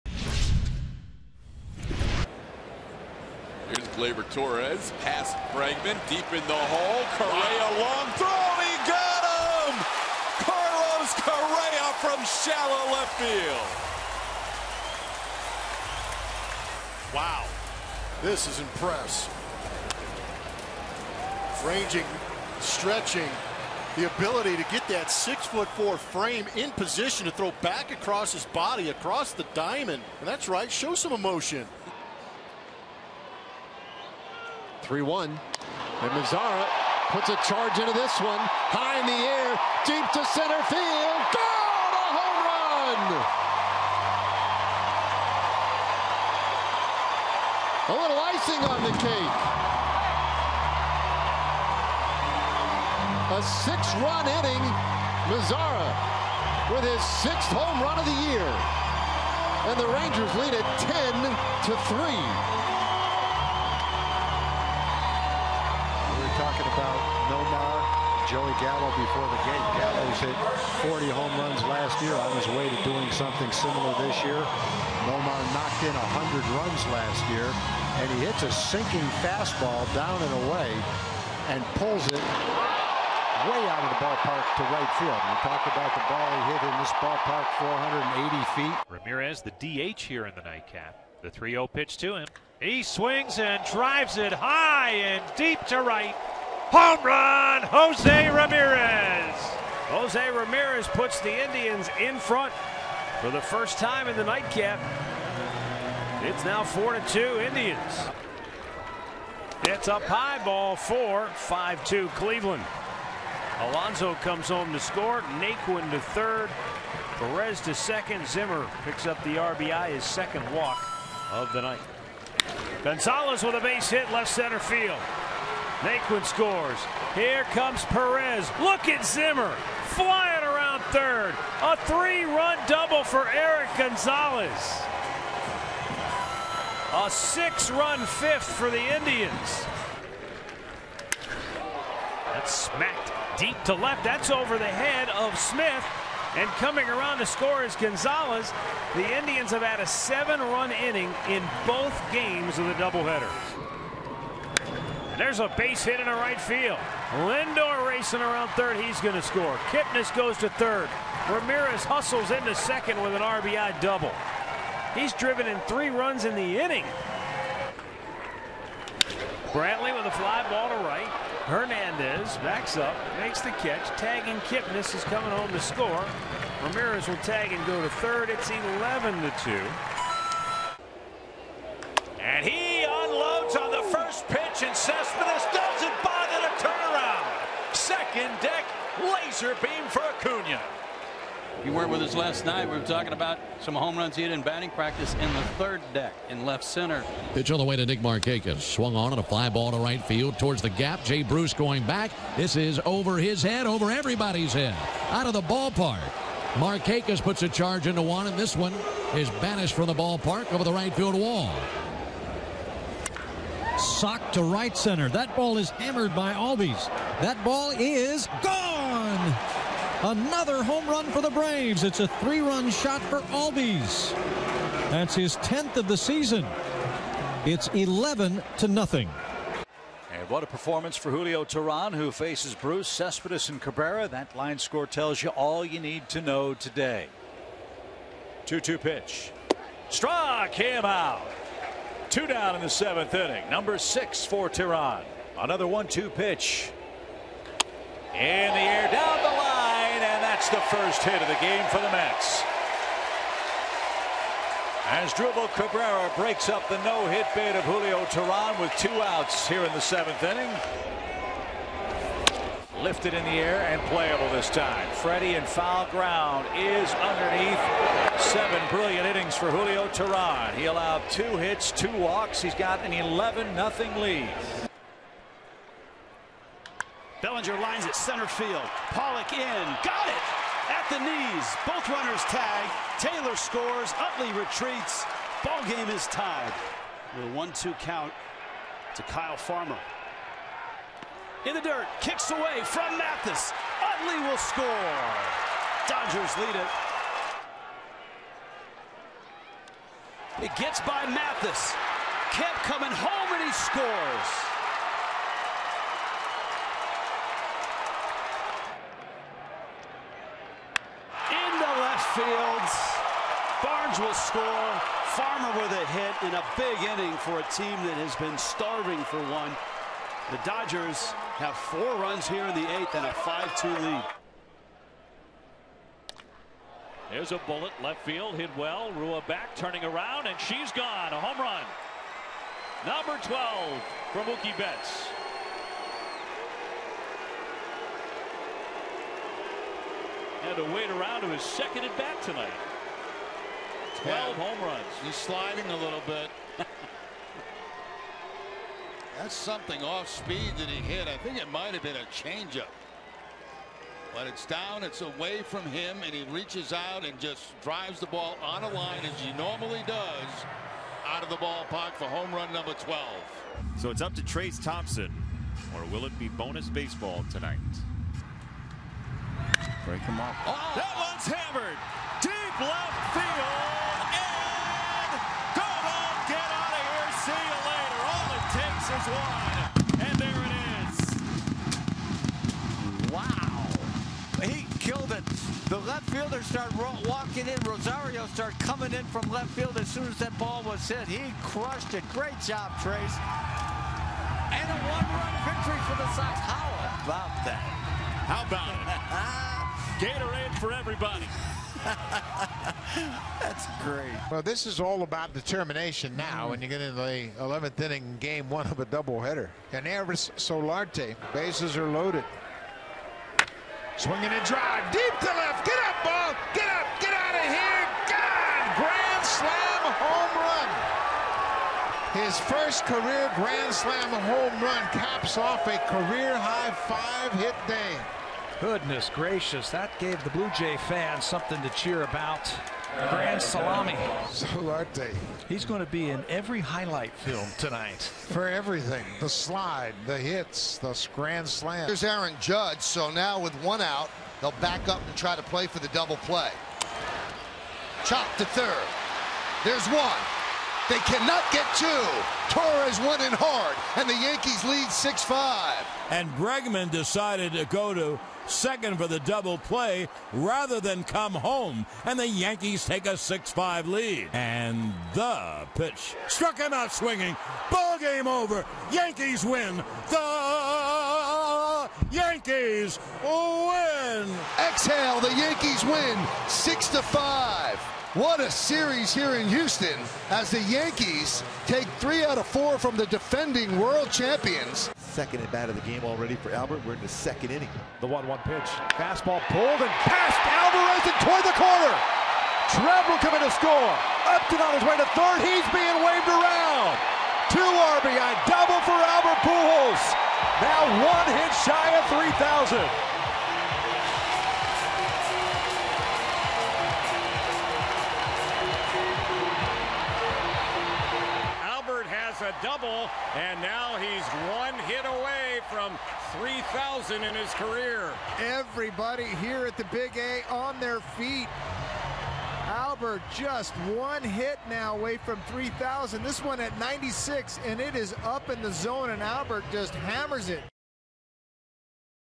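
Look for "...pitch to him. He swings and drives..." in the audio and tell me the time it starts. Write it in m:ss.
1:31.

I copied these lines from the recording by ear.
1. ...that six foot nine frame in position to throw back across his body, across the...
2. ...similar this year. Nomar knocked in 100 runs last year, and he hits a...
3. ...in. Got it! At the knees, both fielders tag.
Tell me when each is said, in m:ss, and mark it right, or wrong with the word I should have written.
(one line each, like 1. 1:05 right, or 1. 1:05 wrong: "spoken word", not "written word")
1. 0:24 wrong: "four", not "nine"
2. 1:13 right
3. 4:39 wrong: "runners", not "fielders".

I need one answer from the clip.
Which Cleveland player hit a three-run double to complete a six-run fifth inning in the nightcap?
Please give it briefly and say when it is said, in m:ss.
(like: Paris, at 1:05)
Erik Gonzalez, at 2:13.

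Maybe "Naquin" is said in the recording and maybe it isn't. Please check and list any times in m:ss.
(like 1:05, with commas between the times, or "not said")
1:55, 2:05.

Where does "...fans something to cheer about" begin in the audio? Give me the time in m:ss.
7:10.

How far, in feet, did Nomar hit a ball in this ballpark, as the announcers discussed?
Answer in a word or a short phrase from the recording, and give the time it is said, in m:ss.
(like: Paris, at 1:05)
480, at 1:27.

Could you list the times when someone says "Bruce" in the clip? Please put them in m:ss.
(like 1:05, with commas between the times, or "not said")
3:21, 3:52.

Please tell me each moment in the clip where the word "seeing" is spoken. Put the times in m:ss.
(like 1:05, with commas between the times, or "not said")
not said.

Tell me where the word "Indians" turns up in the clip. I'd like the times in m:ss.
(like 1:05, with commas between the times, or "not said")
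1:41, 1:47, 2:18, 2:29.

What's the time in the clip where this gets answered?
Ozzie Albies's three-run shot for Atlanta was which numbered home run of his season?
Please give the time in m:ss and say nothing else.
3:45.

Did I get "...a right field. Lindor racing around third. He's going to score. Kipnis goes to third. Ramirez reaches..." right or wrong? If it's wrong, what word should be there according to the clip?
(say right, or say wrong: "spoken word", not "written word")
wrong: "hustles", not "reaches".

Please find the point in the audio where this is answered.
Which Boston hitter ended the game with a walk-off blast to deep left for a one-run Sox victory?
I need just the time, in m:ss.
6:04.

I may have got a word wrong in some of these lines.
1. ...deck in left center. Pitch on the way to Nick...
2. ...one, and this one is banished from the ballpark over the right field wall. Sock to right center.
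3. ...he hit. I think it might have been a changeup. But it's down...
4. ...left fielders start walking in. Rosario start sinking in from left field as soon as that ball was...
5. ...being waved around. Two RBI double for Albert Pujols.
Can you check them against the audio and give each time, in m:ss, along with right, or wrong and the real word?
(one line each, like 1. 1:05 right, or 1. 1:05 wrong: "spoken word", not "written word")
1. 3:15 right
2. 3:28 right
3. 5:50 right
4. 6:25 wrong: "coming", not "sinking"
5. 8:15 right.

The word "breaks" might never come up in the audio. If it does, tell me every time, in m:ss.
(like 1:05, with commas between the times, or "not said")
4:16, 6:09.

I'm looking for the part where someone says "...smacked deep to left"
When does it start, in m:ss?
2:22.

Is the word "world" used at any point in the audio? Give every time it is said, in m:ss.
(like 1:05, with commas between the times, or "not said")
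8:03.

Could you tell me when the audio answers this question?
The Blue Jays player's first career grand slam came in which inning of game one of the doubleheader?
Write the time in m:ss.
6:47.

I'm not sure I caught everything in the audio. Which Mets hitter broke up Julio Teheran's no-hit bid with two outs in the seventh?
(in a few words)
Asdrubal Cabrera.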